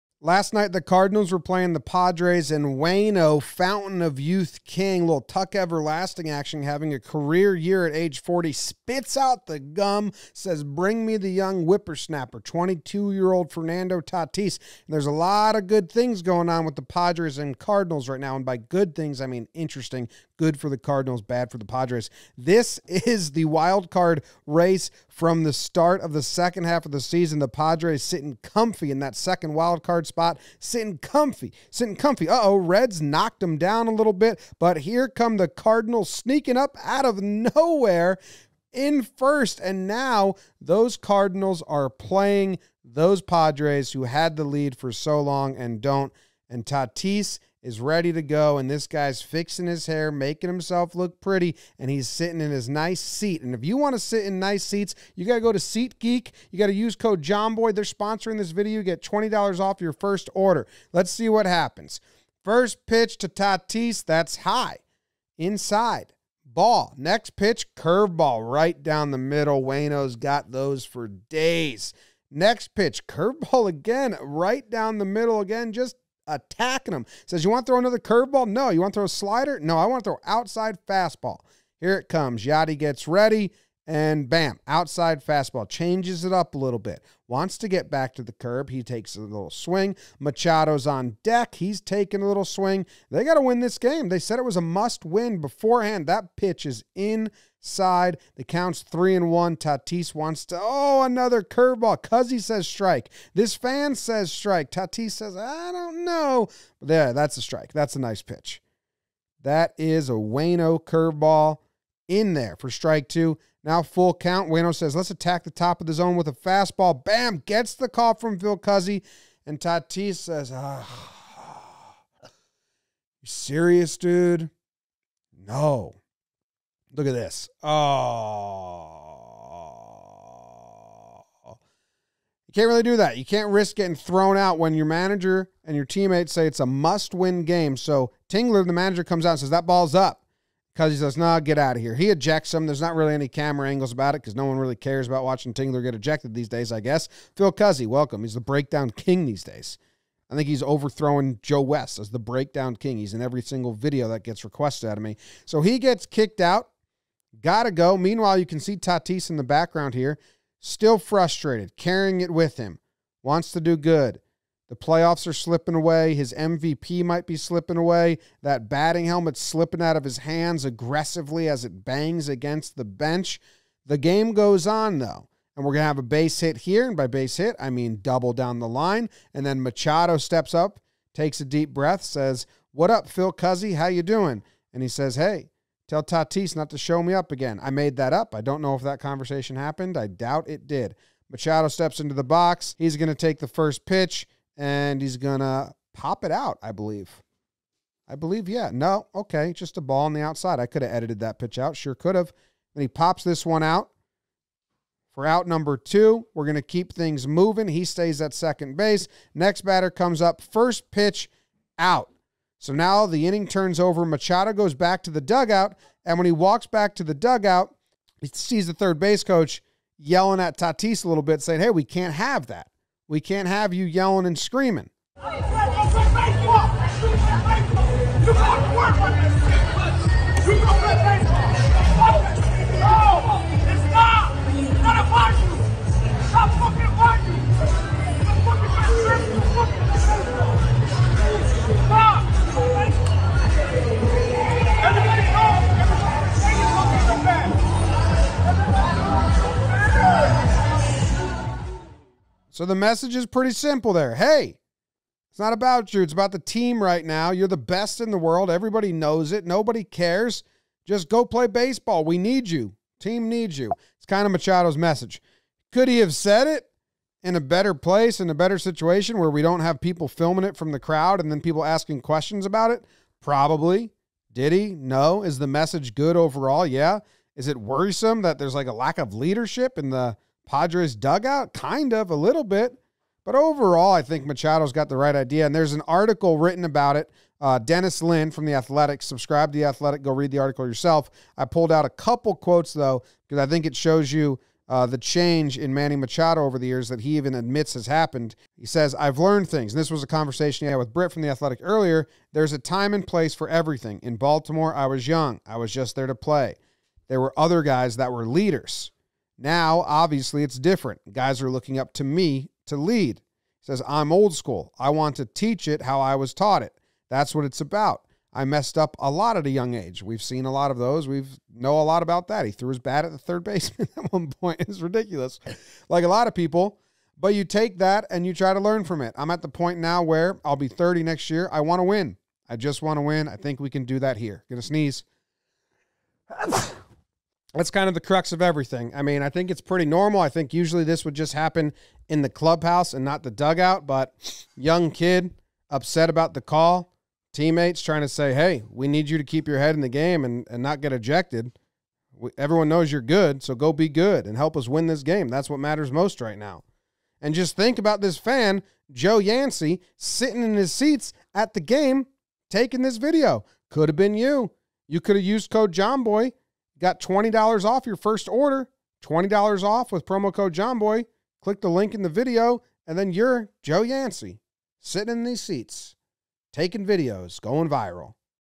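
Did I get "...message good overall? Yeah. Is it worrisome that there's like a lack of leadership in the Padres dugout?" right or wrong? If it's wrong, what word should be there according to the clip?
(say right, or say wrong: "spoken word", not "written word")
right.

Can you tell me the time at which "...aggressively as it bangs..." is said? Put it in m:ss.
2:50.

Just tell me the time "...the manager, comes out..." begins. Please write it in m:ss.
2:18.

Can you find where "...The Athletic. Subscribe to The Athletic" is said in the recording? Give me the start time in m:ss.
4:48.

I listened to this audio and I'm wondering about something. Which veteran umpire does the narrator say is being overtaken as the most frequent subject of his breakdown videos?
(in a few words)
Joe West.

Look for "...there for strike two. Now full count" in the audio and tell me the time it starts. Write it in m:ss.
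1:52.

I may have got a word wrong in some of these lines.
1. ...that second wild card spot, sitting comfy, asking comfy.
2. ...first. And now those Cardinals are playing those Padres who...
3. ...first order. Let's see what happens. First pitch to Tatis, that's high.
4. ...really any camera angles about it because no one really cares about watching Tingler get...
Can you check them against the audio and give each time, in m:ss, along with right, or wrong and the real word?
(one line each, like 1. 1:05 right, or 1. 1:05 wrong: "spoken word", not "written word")
1. 0:28 wrong: "sitting", not "asking"
2. 0:39 right
3. 0:59 right
4. 2:22 right.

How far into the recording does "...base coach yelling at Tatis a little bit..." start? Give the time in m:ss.
3:38.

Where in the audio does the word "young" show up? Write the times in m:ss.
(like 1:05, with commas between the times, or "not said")
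0:11, 5:05, 5:19, 5:44.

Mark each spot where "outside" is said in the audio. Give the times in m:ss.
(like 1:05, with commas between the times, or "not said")
1:20, 1:24, 3:20.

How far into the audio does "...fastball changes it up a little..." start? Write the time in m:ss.
1:25.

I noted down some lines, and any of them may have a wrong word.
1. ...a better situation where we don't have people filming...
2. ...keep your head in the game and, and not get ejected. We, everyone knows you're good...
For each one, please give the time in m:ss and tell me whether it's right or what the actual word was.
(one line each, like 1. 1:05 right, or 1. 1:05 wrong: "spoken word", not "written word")
1. 4:28 right
2. 5:49 right.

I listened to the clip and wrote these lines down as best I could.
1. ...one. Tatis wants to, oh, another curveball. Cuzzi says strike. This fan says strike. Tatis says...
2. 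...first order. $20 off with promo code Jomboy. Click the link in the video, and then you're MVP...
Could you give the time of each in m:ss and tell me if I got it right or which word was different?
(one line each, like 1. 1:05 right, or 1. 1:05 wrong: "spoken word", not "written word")
1. 1:39 right
2. 6:07 wrong: "Joe", not "MVP".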